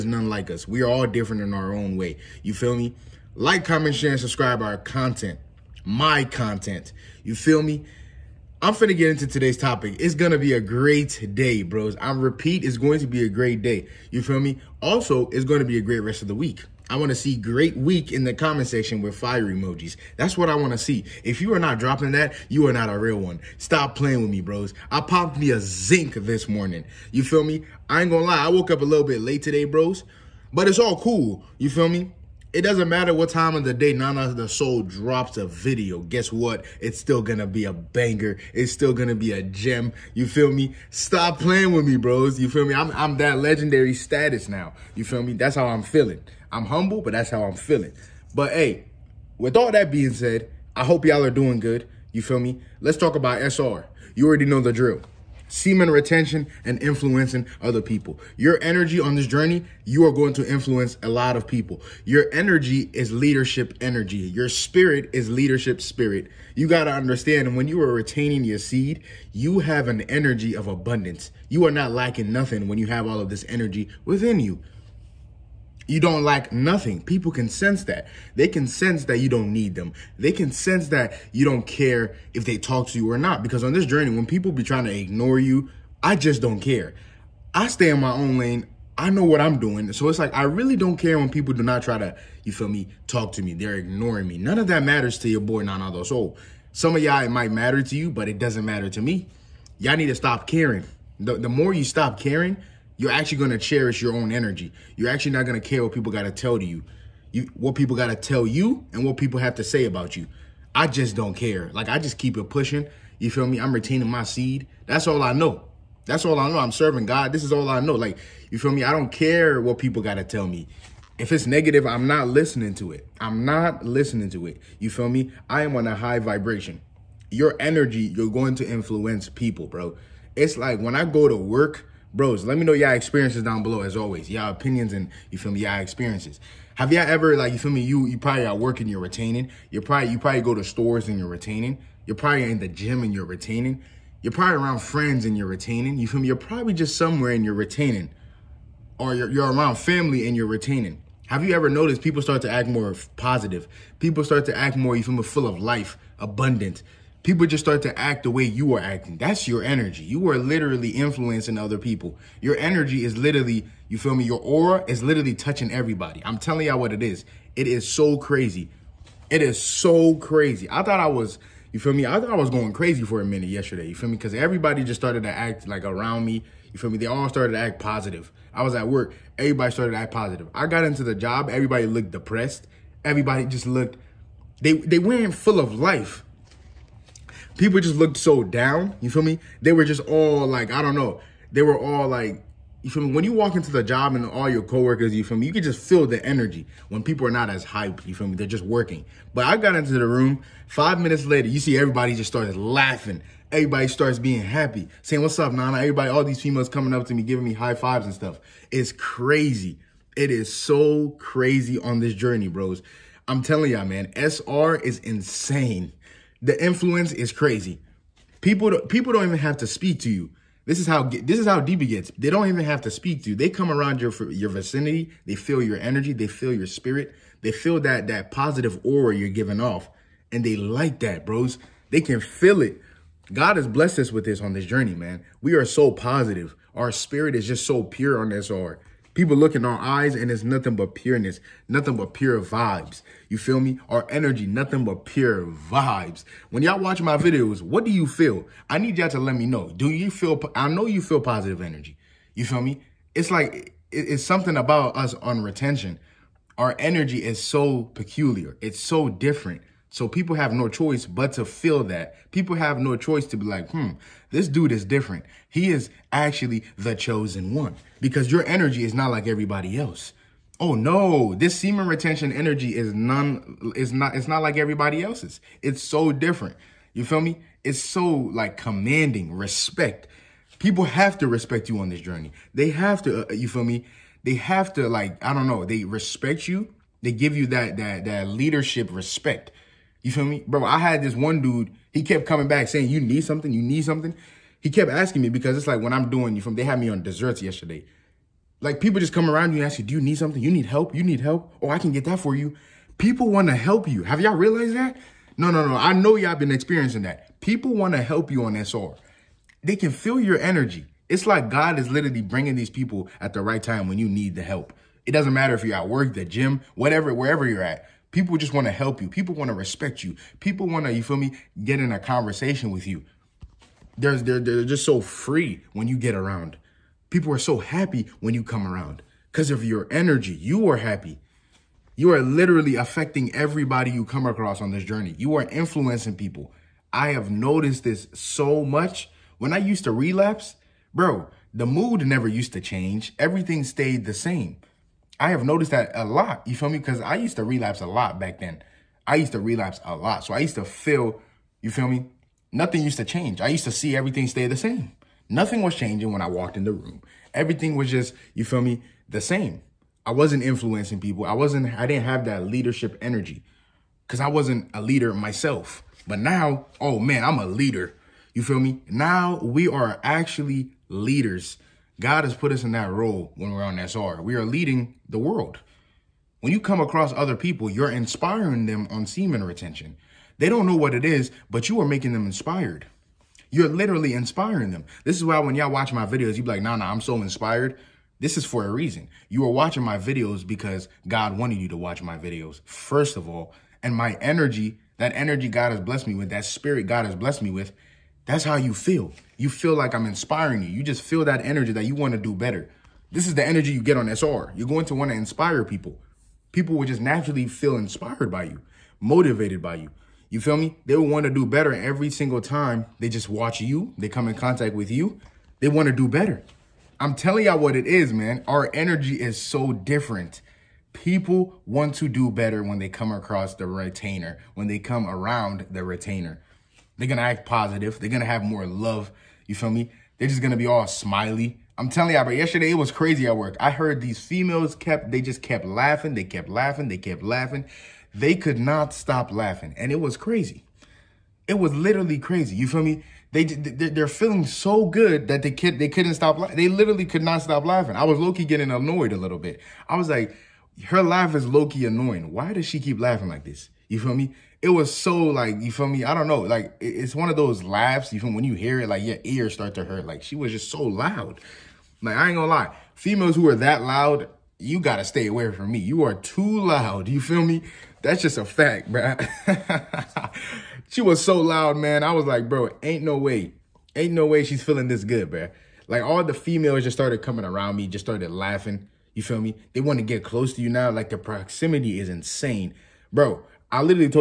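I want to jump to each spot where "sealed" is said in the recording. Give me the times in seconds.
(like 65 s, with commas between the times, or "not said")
not said.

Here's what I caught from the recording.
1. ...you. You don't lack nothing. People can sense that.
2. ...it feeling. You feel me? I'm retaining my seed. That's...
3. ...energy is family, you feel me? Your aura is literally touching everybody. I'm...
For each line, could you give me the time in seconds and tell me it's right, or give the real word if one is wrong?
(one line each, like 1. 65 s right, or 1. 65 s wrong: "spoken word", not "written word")
1. 74 s right
2. 112 s wrong: "pushing", not "feeling"
3. 162 s wrong: "literally", not "family".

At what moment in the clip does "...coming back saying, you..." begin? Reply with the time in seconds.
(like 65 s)
292 s.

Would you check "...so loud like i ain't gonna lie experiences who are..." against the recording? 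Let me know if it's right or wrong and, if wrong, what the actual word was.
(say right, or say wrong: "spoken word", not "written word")
wrong: "females", not "experiences".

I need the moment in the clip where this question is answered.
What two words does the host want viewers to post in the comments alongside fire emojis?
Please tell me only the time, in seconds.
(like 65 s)
17 s.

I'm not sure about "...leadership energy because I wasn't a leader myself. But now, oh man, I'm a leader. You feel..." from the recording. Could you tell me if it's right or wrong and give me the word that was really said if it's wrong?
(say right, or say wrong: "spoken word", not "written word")
right.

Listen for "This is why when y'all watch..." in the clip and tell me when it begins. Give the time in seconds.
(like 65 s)
385 s.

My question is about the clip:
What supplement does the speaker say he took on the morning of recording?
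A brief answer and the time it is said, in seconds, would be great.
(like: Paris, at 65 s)
Zinc, at 25 s.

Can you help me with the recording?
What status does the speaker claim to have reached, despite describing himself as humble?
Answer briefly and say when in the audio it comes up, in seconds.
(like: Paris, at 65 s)
Legendary status, at 43 s.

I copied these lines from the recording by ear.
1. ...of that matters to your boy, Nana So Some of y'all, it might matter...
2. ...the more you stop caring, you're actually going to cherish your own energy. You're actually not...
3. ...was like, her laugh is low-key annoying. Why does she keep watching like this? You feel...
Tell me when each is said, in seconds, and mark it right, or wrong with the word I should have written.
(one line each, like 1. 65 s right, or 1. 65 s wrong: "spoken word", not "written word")
1. 94 s right
2. 101 s right
3. 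449 s wrong: "laughing", not "watching".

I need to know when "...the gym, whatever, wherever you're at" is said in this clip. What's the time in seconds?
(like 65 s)
316 s.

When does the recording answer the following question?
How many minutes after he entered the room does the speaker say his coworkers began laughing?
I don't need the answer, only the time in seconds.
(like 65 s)
200 s.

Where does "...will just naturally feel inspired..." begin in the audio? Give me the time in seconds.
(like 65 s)
406 s.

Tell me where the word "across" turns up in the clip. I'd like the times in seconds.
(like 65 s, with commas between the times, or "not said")
334 s, 376 s, 423 s.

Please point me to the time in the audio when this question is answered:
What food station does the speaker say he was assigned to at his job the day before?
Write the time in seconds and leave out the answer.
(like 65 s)
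297 s.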